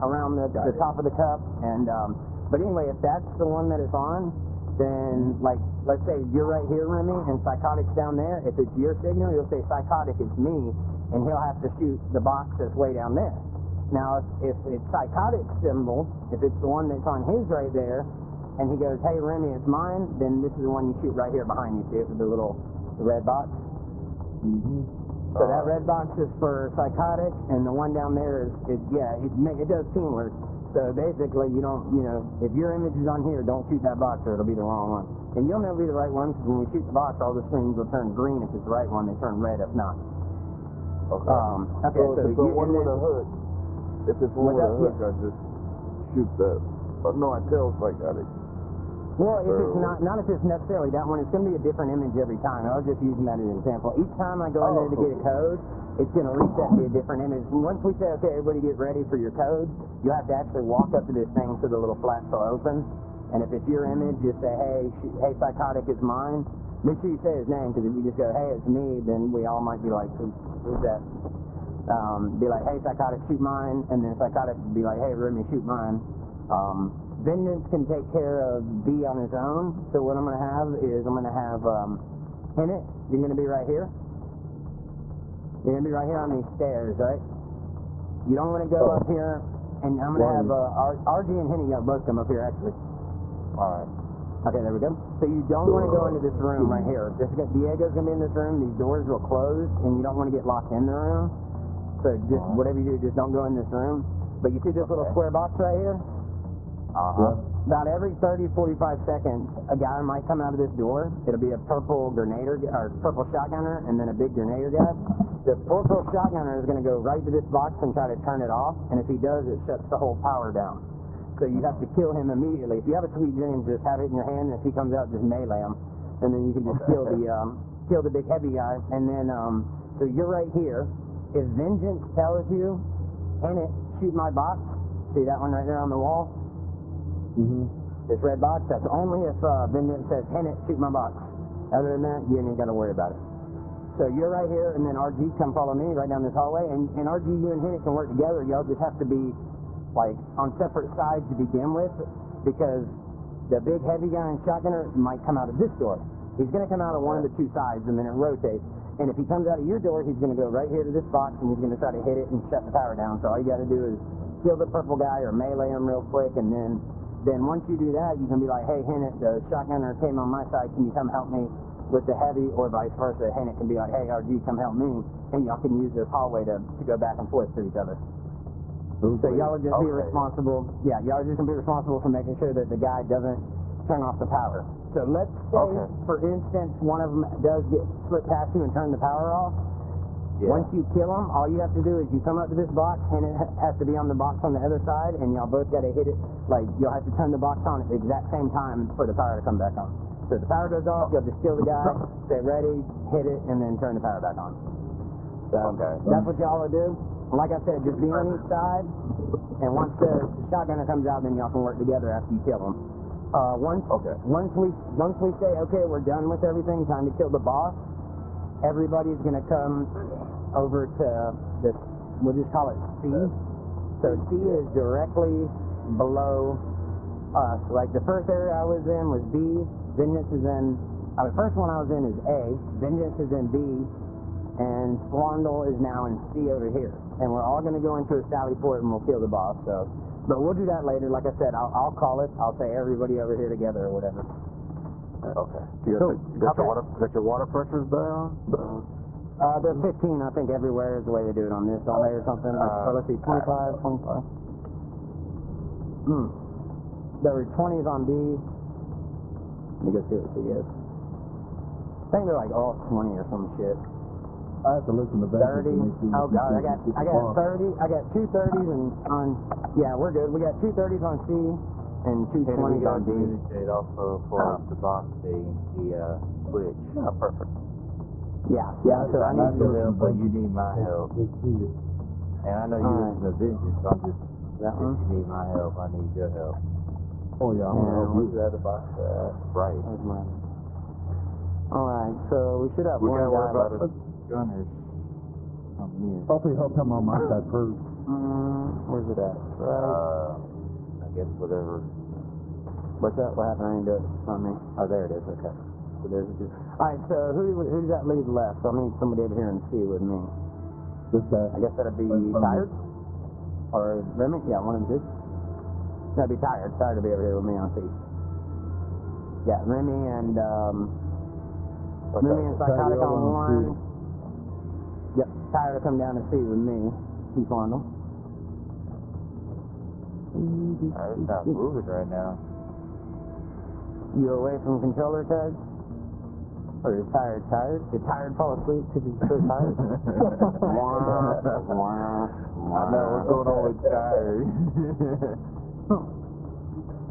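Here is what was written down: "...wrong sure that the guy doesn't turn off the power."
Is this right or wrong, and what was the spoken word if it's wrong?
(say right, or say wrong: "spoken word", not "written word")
wrong: "making", not "wrong".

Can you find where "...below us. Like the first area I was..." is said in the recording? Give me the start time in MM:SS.
03:45.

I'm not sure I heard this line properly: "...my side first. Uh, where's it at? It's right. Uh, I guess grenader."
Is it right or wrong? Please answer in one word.
wrong.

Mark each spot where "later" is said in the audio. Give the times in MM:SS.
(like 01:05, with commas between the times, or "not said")
04:00.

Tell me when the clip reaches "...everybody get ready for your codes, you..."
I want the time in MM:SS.
00:58.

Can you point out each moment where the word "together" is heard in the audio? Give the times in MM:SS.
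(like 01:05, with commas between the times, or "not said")
02:28, 03:31, 04:03.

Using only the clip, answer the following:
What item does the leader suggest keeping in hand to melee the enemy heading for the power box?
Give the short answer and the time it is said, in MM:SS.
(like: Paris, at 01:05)
sweet dreams, at 02:03.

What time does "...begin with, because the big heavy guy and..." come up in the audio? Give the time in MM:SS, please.
02:31.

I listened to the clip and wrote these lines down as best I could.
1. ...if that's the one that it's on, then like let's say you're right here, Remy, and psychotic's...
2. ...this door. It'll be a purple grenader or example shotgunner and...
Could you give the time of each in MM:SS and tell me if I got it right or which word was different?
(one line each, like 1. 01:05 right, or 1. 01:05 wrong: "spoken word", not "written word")
1. 00:02 right
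2. 01:50 wrong: "purple", not "example".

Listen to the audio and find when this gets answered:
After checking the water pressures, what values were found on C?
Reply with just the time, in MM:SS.
04:30.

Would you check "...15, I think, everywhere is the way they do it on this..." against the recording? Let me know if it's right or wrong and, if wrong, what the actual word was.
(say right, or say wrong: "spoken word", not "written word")
right.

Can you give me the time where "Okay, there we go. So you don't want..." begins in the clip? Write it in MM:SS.
01:34.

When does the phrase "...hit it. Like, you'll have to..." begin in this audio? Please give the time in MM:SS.
03:15.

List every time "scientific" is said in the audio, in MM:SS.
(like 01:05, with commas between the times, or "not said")
not said.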